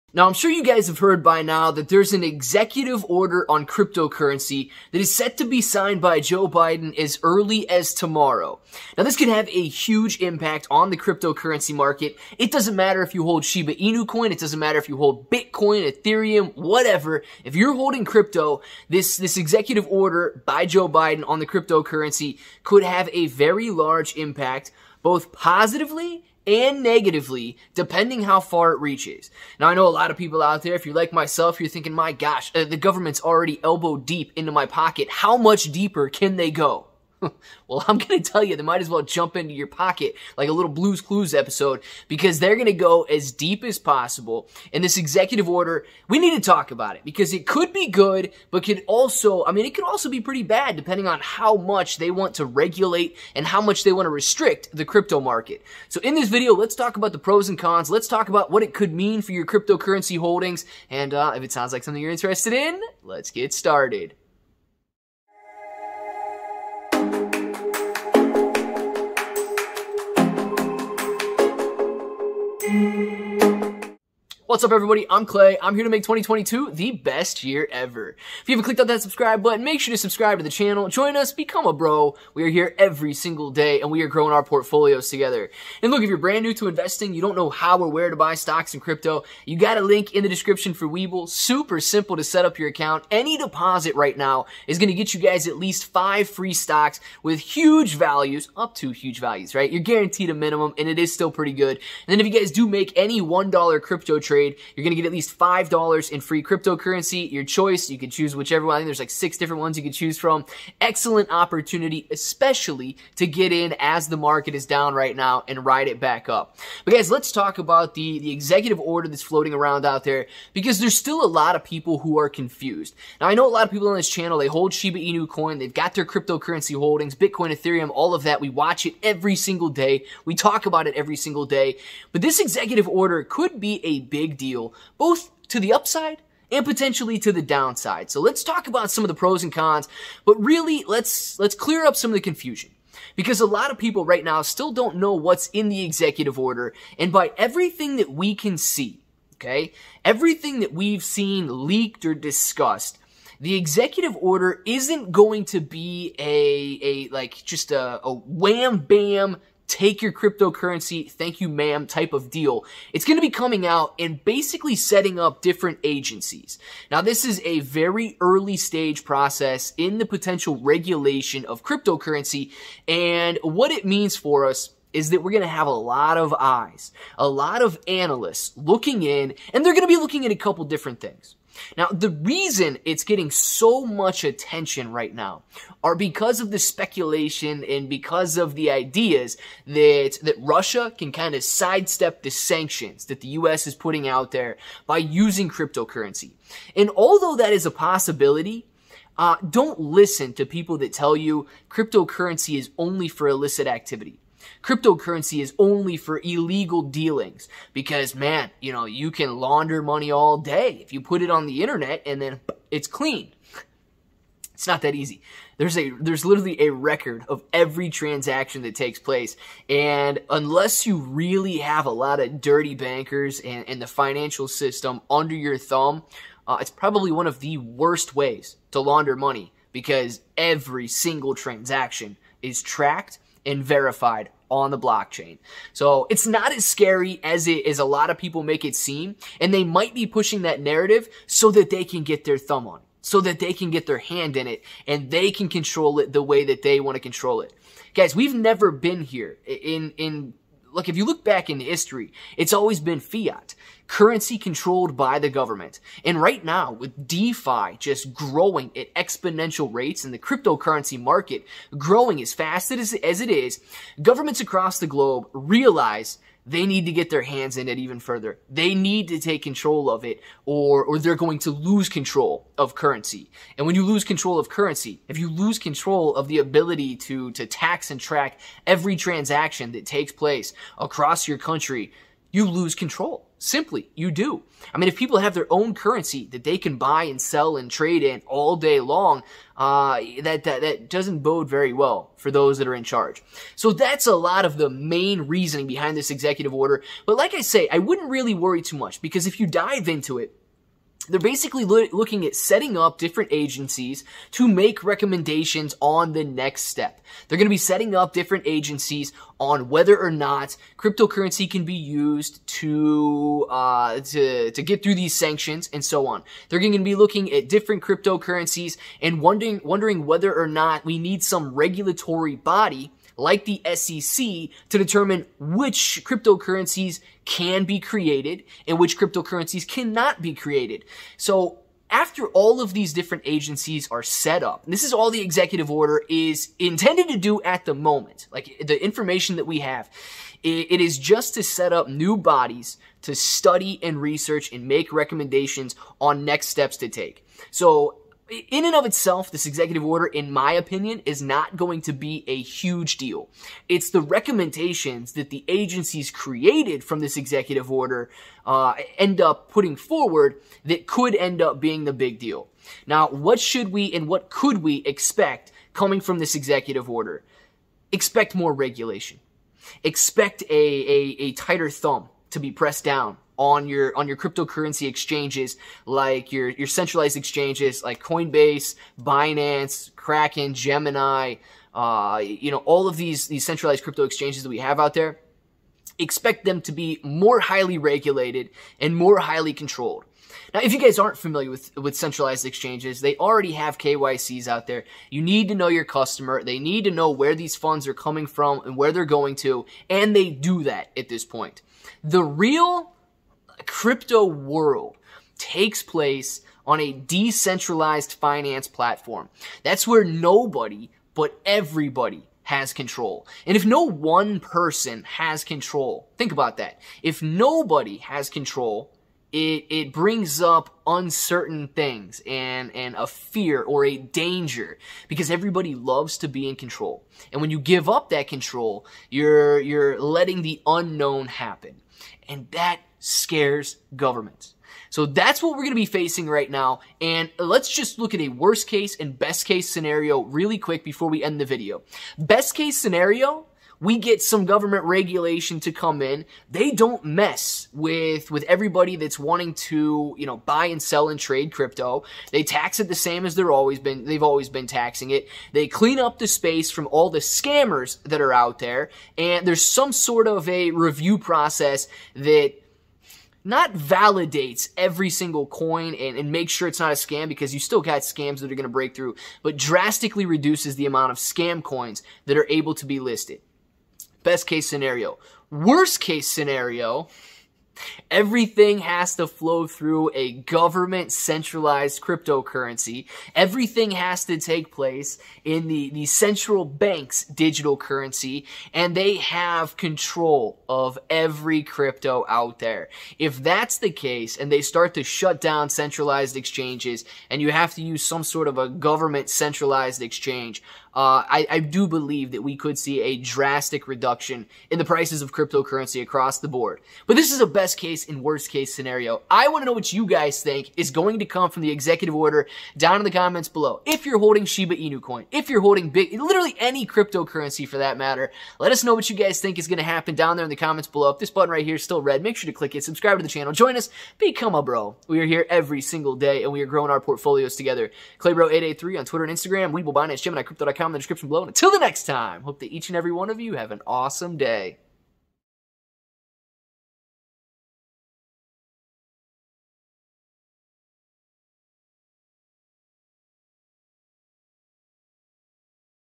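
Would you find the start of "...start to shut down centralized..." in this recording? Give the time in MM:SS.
08:14.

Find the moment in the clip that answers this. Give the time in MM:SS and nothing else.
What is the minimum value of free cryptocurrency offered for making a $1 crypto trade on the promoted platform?
01:45.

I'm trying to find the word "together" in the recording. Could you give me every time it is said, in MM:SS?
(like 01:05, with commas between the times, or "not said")
01:25, 08:47.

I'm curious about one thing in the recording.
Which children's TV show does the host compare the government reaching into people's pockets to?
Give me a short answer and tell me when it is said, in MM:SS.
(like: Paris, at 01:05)
Blues Clues, at 00:40.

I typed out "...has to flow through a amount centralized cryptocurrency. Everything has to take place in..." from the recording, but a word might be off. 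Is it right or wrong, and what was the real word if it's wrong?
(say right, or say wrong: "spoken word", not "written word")
wrong: "government", not "amount".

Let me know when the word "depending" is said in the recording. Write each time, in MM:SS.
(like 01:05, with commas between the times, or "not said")
00:27, 00:50.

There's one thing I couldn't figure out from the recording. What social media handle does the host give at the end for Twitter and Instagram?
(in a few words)
Claybro883.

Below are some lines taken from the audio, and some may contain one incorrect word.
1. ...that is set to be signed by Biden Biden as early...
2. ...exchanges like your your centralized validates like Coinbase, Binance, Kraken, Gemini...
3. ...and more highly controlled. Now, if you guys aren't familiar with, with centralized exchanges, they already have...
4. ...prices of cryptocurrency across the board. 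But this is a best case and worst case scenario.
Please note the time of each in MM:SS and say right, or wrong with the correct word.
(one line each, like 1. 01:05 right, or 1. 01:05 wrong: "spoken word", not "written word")
1. 00:04 wrong: "Joe", not "Biden"
2. 06:14 wrong: "exchanges", not "validates"
3. 06:28 right
4. 08:24 right.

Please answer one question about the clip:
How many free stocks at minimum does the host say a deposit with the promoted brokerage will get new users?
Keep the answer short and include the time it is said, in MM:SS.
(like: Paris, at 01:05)
5, at 01:35.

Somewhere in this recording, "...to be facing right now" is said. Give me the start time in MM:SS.
07:15.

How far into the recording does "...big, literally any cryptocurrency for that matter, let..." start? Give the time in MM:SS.
08:35.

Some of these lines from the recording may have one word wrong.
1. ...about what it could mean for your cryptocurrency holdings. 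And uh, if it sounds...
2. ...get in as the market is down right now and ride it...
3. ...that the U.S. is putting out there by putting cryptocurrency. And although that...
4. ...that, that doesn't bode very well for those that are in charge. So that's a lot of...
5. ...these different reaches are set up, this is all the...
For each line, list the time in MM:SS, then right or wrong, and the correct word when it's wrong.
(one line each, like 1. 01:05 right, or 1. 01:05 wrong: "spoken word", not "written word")
1. 00:58 right
2. 01:53 right
3. 03:13 wrong: "using", not "putting"
4. 04:50 right
5. 05:32 wrong: "agencies", not "reaches".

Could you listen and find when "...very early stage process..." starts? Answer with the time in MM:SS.
02:47.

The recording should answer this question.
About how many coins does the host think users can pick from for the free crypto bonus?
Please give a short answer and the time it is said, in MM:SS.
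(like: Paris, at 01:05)
6, at 01:49.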